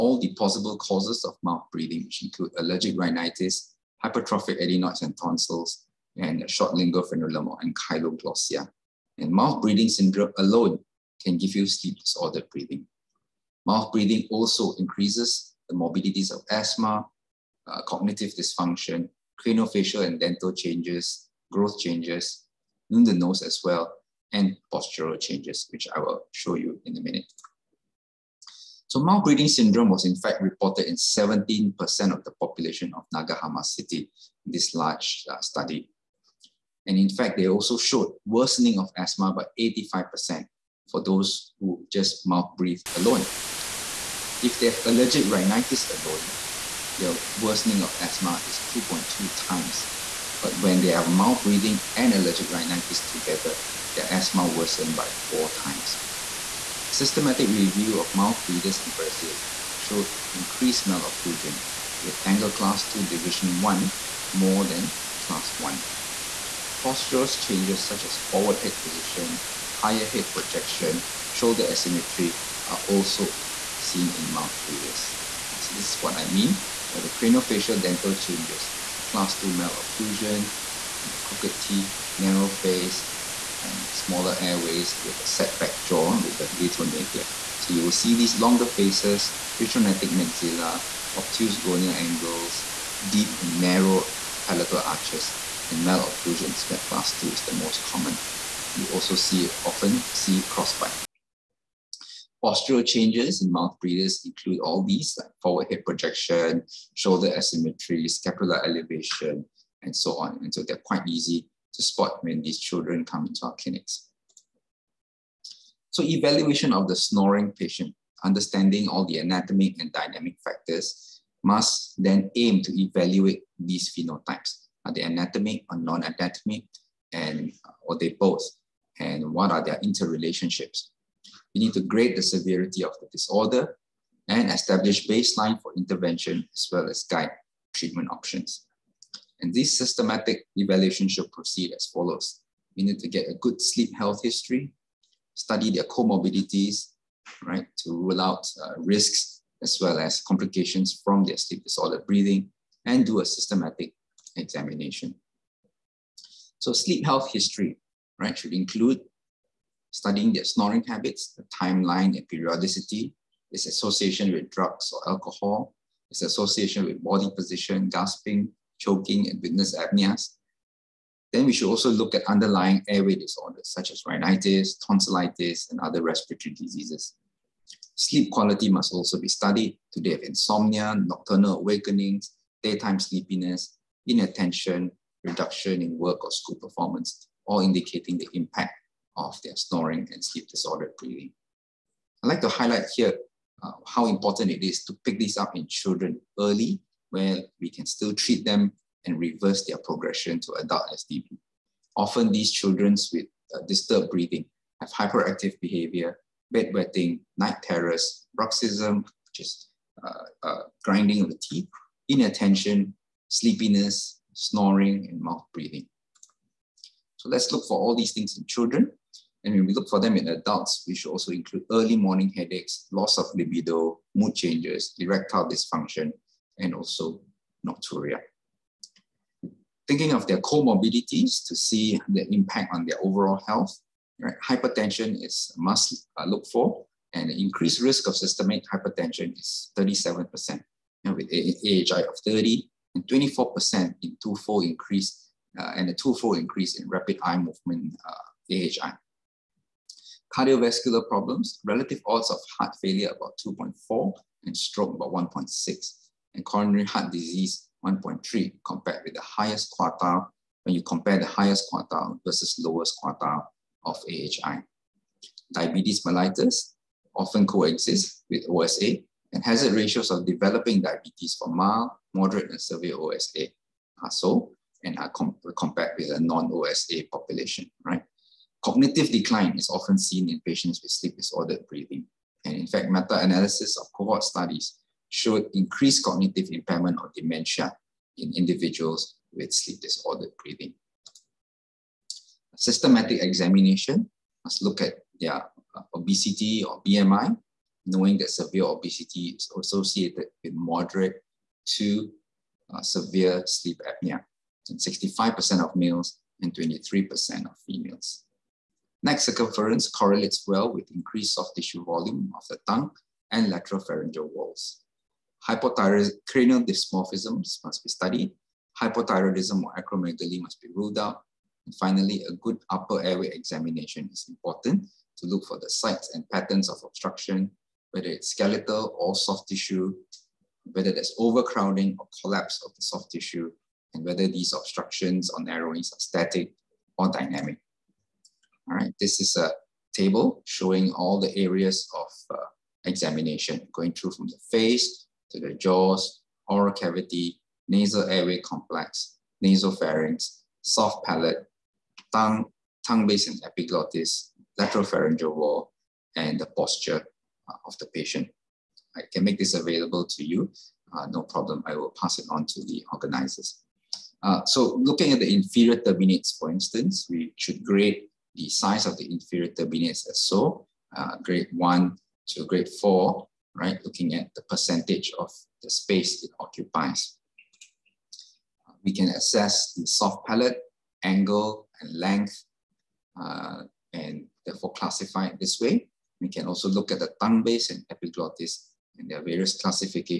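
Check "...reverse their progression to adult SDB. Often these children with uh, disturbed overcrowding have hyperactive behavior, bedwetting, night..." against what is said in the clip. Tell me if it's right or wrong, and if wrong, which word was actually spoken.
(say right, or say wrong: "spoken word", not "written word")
wrong: "breathing", not "overcrowding".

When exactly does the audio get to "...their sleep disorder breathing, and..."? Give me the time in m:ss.
2:31.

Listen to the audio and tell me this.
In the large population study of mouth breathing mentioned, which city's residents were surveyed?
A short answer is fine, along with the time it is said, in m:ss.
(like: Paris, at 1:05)
Nagahama City, at 0:33.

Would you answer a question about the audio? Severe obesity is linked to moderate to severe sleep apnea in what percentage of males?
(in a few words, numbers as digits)
65%.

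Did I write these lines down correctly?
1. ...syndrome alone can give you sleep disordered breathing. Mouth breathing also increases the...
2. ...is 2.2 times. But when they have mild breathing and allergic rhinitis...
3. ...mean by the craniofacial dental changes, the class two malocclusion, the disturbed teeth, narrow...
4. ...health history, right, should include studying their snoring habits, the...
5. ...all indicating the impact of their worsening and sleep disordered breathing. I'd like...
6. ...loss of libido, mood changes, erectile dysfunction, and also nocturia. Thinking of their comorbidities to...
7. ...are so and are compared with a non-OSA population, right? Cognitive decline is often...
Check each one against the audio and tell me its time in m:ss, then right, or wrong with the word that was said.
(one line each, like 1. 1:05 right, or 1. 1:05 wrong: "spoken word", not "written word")
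1. 0:09 right
2. 0:48 right
3. 1:16 wrong: "crooked", not "disturbed"
4. 2:37 right
5. 3:07 wrong: "snoring", not "worsening"
6. 3:42 right
7. 4:34 right.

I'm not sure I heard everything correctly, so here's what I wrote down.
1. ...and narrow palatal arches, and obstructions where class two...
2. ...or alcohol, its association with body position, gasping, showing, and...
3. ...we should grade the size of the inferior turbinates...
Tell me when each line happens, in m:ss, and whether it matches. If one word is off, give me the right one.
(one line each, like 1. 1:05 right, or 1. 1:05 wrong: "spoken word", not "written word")
1. 1:33 wrong: "malocclusions", not "obstructions"
2. 2:44 wrong: "choking", not "showing"
3. 6:07 right.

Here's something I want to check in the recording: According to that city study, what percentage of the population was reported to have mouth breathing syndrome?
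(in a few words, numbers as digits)
17%.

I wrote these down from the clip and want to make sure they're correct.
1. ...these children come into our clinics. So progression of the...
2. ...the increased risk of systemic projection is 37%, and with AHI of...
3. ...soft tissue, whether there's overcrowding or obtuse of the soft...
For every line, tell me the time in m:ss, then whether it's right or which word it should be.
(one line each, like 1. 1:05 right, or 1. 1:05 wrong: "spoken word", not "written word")
1. 1:52 wrong: "evaluation", not "progression"
2. 3:57 wrong: "hypertension", not "projection"
3. 5:29 wrong: "collapse", not "obtuse".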